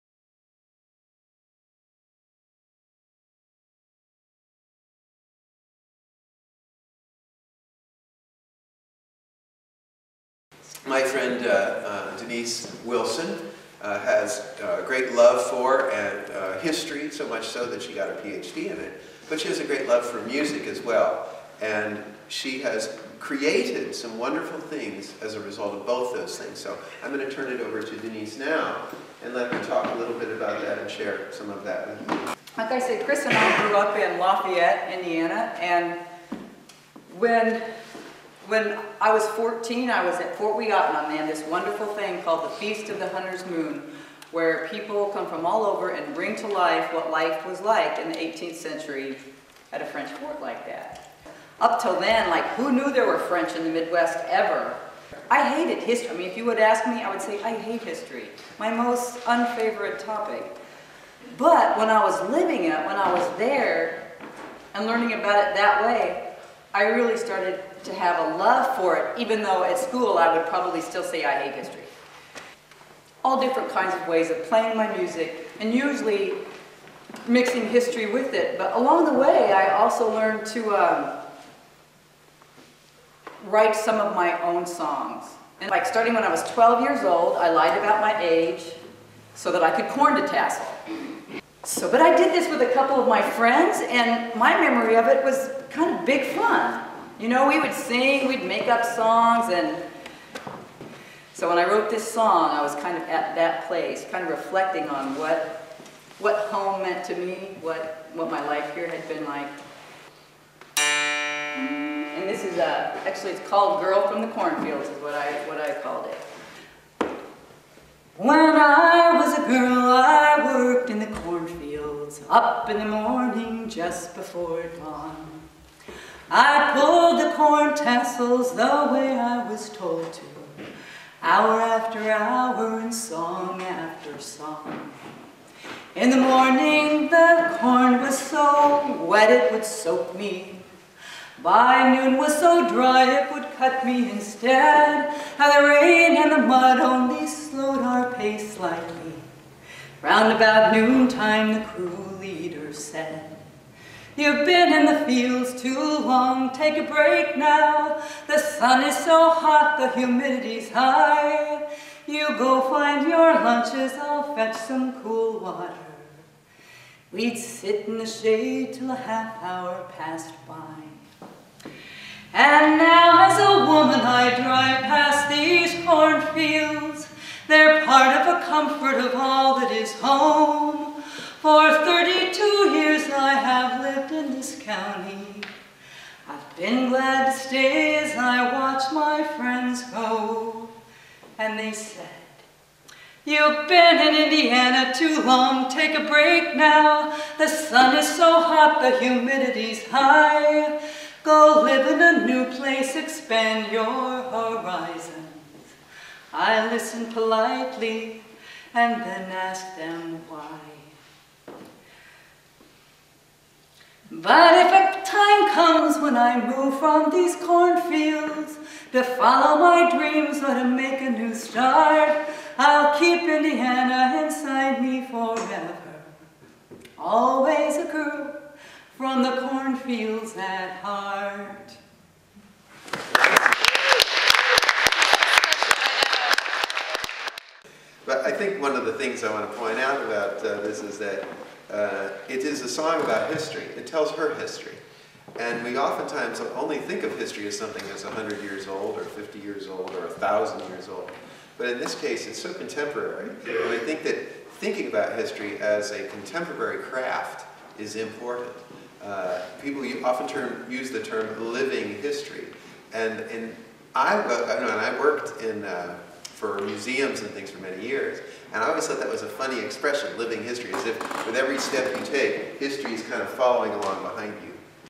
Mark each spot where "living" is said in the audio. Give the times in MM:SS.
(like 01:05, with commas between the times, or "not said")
01:02, 04:21, 04:30.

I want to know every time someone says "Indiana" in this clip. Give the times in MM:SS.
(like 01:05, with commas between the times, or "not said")
00:34, 03:14, 03:43.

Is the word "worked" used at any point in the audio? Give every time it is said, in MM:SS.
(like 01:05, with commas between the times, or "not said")
02:00, 04:24.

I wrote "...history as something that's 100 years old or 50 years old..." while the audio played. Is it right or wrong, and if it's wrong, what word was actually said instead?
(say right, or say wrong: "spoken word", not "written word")
right.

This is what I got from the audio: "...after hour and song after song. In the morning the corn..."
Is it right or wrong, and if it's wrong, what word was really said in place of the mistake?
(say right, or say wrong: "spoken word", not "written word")
right.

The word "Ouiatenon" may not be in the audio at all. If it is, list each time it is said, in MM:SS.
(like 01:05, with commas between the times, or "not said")
00:40.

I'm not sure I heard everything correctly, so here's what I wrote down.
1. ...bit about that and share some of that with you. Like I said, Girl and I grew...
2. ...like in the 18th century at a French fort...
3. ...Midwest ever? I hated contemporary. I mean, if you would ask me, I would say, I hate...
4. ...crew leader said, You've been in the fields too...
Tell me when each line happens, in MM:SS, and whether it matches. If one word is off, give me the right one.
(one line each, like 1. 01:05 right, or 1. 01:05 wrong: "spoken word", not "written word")
1. 00:30 wrong: "Chris", not "Girl"
2. 00:47 right
3. 00:53 wrong: "history", not "contemporary"
4. 02:31 right.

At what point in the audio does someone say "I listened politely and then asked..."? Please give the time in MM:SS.
03:26.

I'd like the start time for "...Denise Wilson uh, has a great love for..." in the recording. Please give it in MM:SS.
00:12.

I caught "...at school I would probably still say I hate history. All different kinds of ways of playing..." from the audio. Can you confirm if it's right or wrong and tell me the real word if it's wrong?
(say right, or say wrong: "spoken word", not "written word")
right.